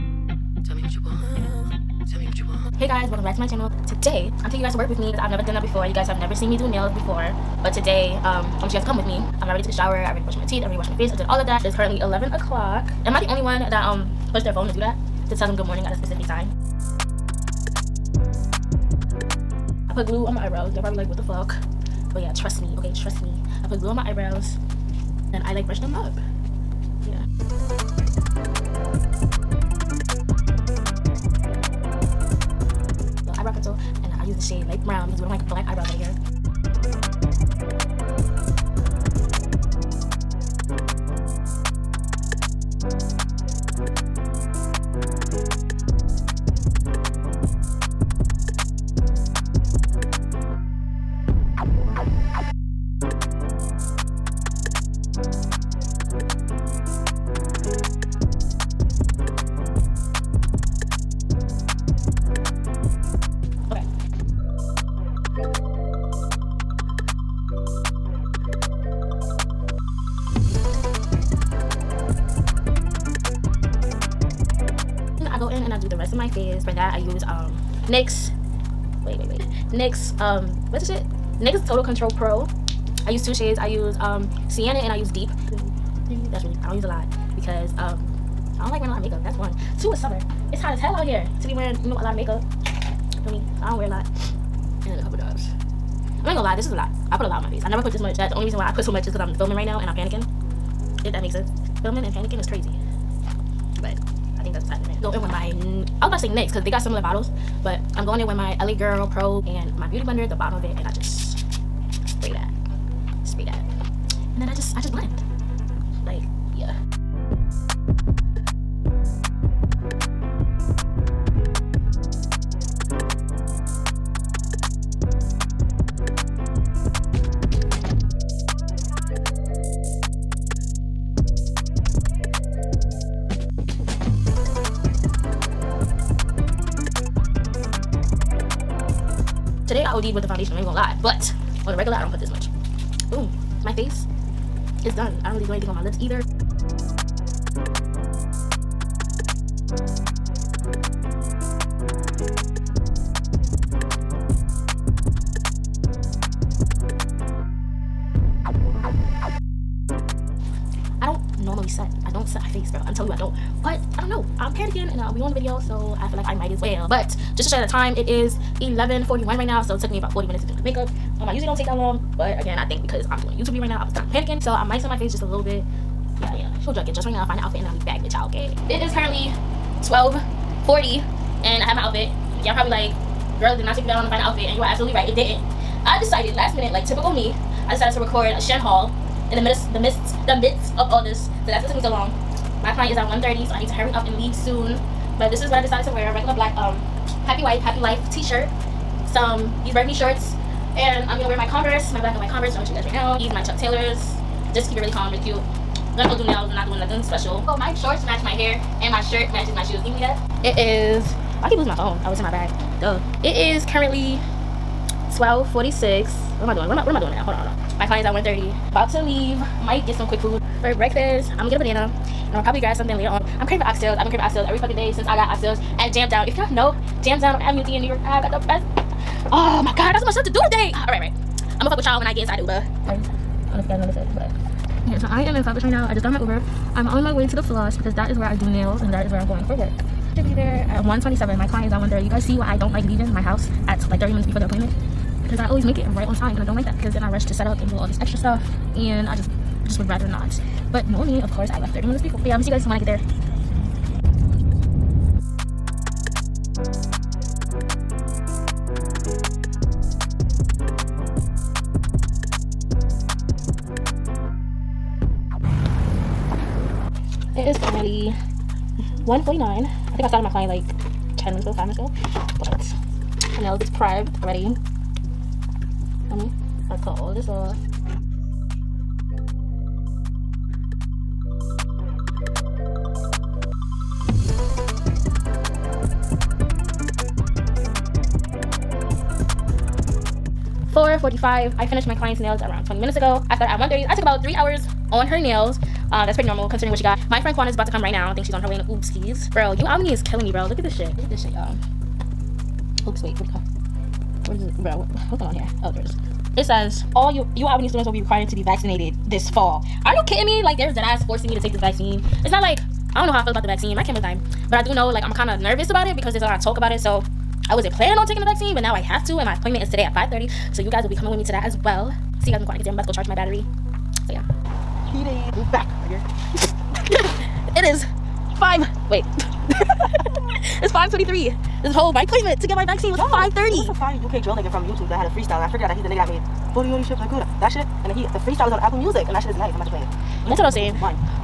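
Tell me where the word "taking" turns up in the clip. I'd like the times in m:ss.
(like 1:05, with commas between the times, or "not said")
0:04, 5:18.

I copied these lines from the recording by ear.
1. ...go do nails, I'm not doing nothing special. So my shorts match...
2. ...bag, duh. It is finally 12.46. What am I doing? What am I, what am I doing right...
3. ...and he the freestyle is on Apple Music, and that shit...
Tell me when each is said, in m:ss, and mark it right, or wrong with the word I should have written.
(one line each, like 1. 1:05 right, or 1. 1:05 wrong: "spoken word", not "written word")
1. 3:26 right
2. 3:32 wrong: "currently", not "finally"
3. 5:37 right.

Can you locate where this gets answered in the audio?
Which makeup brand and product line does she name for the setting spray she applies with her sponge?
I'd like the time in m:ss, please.
1:48.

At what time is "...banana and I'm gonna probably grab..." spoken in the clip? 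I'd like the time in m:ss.
3:41.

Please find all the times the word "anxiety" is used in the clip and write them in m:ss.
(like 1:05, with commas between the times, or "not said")
not said.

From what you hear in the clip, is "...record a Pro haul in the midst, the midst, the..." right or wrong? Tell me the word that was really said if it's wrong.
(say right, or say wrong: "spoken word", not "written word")
wrong: "Shein", not "Pro".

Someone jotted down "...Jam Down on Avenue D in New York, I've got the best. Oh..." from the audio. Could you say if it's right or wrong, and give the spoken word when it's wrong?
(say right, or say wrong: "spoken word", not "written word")
right.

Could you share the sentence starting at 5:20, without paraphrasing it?
So you guys will be coming with me to that as well.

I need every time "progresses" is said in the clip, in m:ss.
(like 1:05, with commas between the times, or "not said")
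not said.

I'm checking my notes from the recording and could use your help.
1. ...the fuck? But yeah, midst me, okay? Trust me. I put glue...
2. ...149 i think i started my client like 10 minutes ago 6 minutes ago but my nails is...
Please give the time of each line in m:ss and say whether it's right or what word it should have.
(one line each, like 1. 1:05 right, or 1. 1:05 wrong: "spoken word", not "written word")
1. 0:21 wrong: "trust", not "midst"
2. 4:29 wrong: "5", not "6".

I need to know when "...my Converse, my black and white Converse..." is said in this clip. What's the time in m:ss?
3:21.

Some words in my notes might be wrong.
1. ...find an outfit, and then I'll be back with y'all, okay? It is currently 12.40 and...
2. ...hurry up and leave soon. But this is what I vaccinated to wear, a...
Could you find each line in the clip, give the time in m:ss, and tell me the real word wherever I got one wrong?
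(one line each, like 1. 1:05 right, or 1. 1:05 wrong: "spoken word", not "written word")
1. 2:57 right
2. 3:13 wrong: "decided", not "vaccinated".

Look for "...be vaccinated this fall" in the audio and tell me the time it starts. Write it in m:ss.
5:08.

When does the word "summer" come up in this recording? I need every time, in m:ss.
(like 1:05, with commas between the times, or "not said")
1:29.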